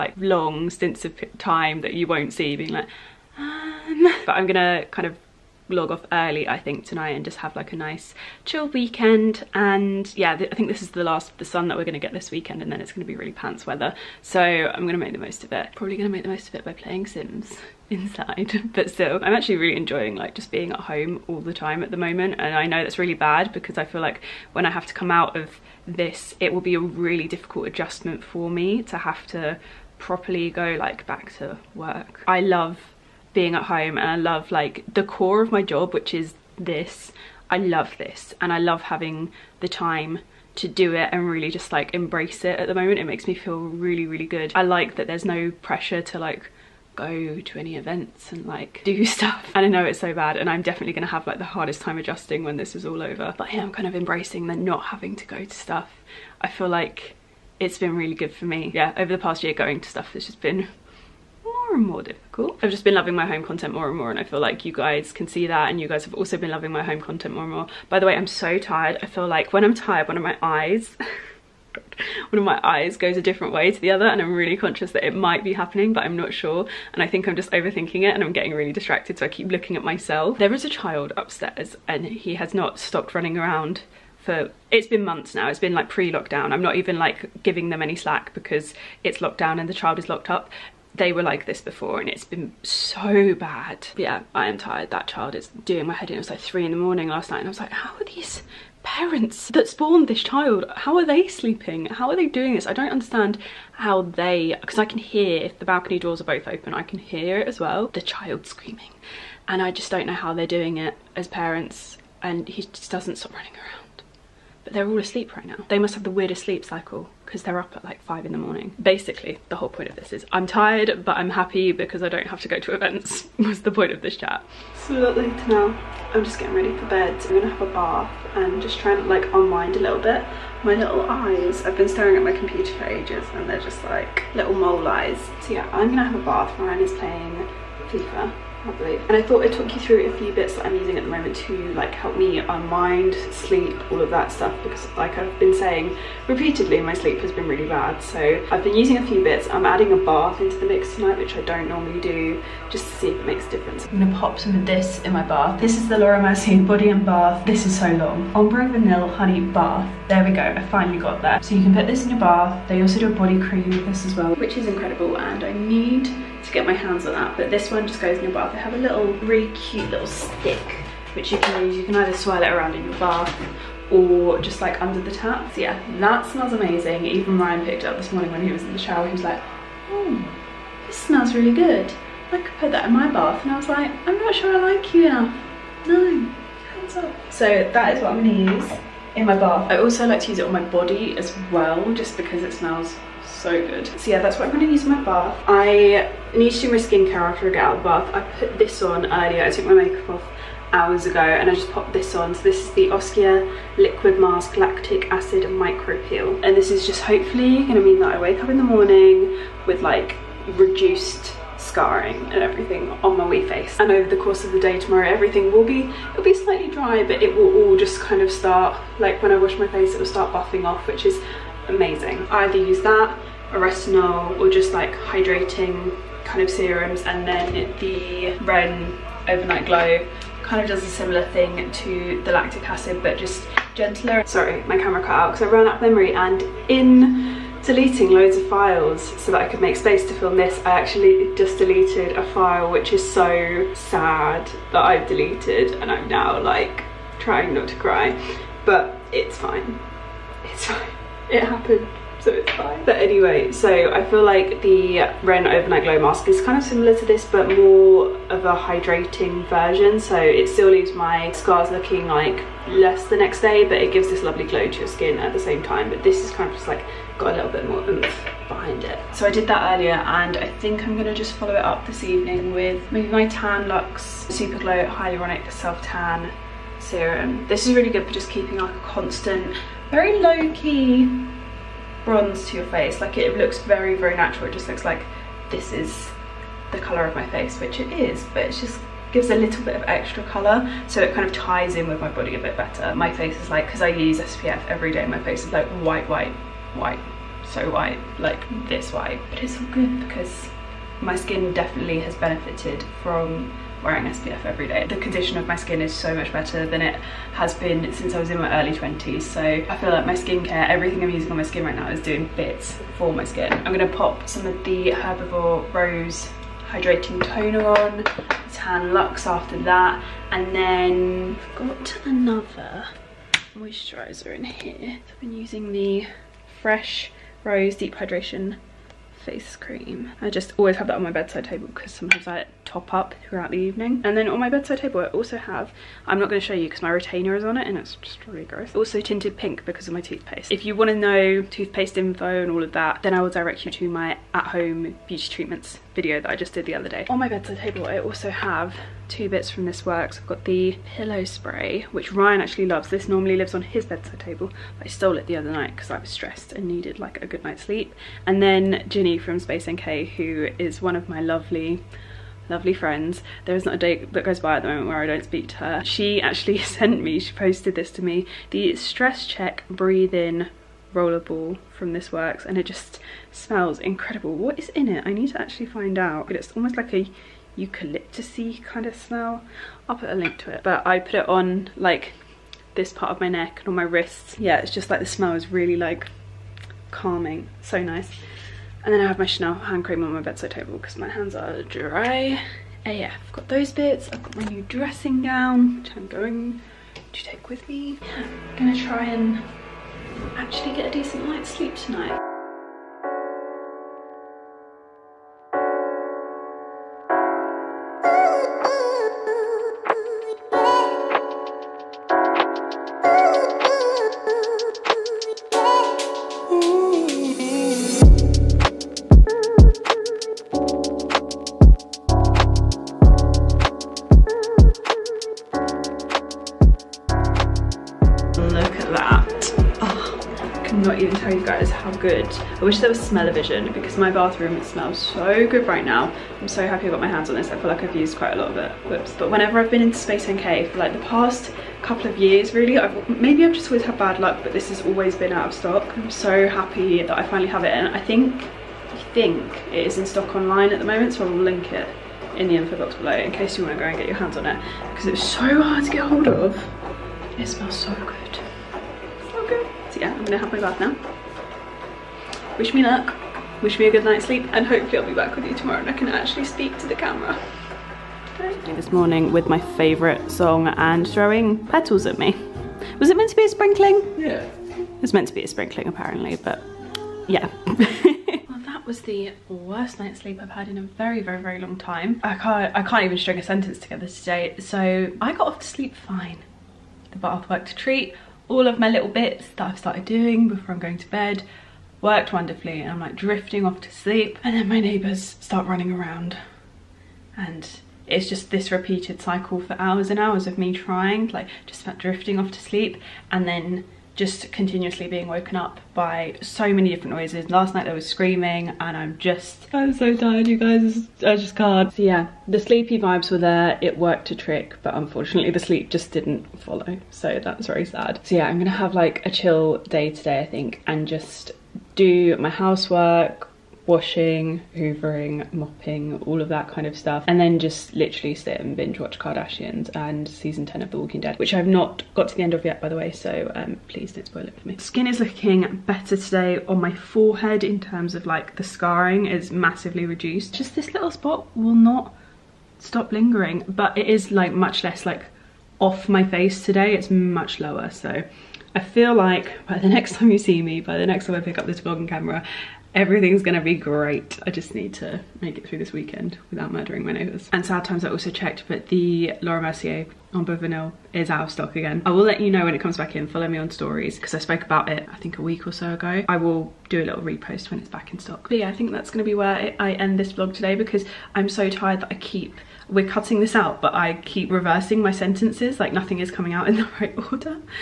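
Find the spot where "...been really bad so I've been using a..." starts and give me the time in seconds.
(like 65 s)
147 s.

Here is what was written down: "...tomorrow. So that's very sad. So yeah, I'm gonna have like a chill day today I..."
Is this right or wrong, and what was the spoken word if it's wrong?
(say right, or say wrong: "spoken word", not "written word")
wrong: "follow", not "tomorrow".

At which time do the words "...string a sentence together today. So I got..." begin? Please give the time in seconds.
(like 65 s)
483 s.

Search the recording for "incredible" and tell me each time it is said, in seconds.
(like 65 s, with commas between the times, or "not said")
164 s, 373 s.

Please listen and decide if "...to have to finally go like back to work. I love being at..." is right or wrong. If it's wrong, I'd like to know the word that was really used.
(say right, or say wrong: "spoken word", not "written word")
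wrong: "properly", not "finally".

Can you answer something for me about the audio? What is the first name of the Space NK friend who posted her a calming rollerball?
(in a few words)
Ginny.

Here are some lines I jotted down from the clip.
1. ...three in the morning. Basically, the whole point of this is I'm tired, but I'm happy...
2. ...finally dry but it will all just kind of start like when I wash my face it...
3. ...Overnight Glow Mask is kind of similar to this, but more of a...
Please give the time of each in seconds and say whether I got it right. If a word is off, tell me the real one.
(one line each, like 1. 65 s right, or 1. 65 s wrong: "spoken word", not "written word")
1. 118 s wrong: "five", not "three"
2. 216 s wrong: "slightly", not "finally"
3. 255 s right.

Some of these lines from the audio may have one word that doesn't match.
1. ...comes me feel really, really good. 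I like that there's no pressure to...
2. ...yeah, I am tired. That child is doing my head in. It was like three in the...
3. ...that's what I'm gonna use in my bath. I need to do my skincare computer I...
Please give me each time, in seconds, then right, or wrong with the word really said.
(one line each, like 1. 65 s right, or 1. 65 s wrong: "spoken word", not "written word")
1. 43 s wrong: "makes", not "comes"
2. 94 s right
3. 194 s wrong: "after", not "computer".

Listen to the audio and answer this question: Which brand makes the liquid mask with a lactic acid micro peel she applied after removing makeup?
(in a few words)
Oskia.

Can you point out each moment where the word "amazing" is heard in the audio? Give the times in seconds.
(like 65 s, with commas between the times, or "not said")
176 s, 221 s.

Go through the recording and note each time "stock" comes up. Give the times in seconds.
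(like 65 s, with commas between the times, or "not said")
445 s, 450 s, 561 s, 568 s.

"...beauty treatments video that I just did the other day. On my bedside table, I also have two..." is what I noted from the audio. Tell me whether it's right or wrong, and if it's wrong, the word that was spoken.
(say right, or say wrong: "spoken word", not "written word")
right.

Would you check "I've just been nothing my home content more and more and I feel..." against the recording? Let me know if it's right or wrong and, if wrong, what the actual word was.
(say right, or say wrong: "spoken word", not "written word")
wrong: "loving", not "nothing".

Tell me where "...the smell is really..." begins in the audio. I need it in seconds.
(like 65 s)
384 s.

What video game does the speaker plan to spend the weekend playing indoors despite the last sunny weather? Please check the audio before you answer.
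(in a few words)
Sims.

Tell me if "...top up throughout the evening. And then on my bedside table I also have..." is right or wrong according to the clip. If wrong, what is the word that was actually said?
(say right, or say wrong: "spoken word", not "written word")
right.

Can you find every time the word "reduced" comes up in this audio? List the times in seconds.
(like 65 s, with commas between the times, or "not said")
210 s, 540 s.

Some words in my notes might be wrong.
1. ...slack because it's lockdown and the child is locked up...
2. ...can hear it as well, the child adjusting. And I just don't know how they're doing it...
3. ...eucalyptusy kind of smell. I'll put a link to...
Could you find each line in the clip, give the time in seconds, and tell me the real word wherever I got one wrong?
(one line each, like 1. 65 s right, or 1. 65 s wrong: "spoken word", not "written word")
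1. 87 s right
2. 106 s wrong: "screaming", not "adjusting"
3. 377 s right.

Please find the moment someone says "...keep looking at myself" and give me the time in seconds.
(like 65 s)
79 s.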